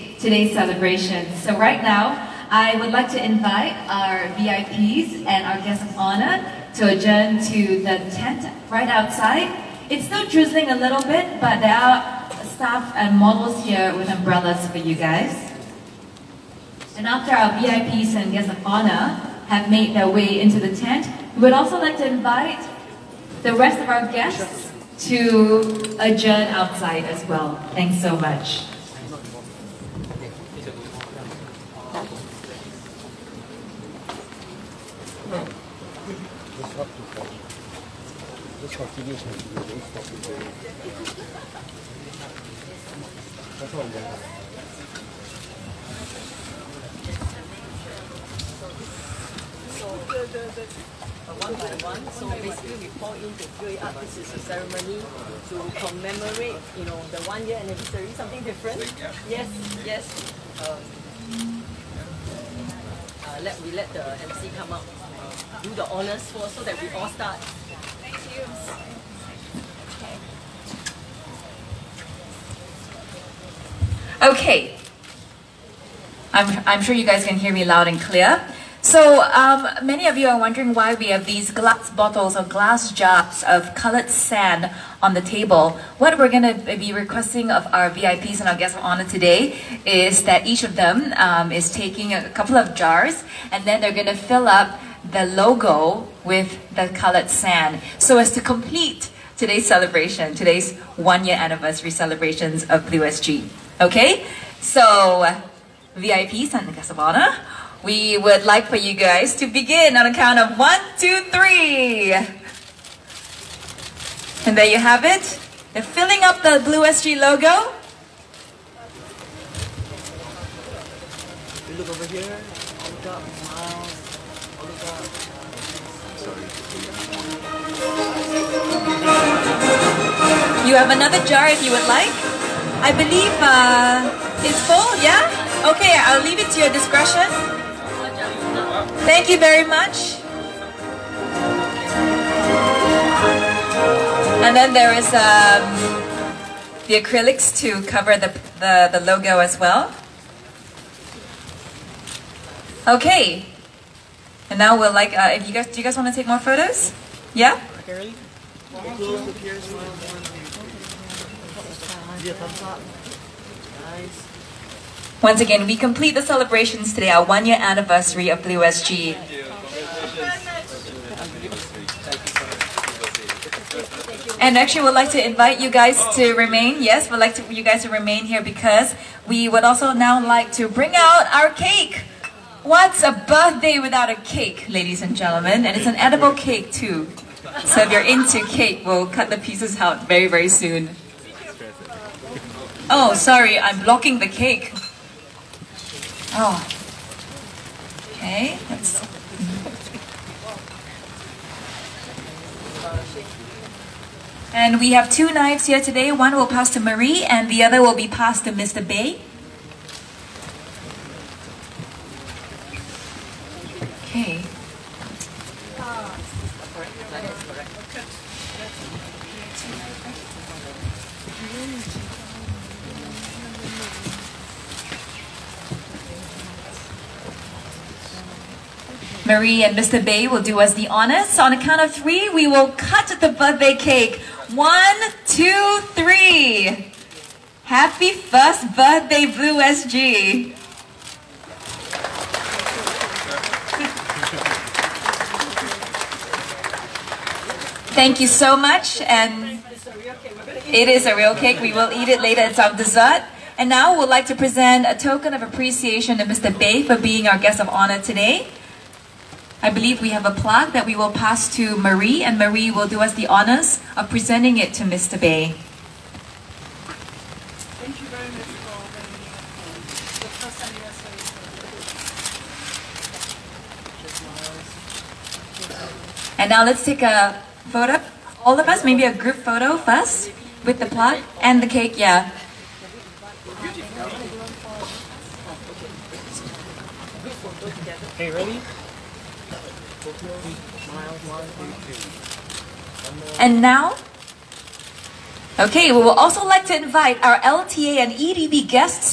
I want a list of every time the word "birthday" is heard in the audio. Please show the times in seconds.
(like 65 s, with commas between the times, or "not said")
183 s, 233 s, 238 s.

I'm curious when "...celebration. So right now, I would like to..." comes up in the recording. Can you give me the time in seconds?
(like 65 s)
0 s.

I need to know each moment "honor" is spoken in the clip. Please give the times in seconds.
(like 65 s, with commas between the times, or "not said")
5 s, 18 s, 65 s, 88 s, 106 s, 230 s, 257 s, 263 s.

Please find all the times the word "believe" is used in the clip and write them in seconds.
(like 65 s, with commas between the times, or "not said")
132 s, 259 s.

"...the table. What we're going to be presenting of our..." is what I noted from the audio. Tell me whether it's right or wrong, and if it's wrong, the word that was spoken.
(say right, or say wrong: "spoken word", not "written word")
wrong: "requesting", not "presenting".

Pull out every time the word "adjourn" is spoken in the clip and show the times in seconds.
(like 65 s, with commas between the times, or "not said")
6 s, 25 s.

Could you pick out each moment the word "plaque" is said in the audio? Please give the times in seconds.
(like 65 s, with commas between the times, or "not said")
260 s, 280 s.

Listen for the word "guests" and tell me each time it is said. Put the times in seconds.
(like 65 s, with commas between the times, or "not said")
5 s, 18 s, 24 s, 88 s, 106 s, 257 s.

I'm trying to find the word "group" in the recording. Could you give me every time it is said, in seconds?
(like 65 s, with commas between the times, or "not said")
279 s.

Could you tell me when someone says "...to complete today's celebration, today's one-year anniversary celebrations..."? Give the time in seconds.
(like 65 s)
98 s.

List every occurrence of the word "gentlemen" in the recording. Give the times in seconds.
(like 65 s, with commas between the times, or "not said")
185 s.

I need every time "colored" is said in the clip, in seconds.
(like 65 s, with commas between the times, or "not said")
83 s, 96 s.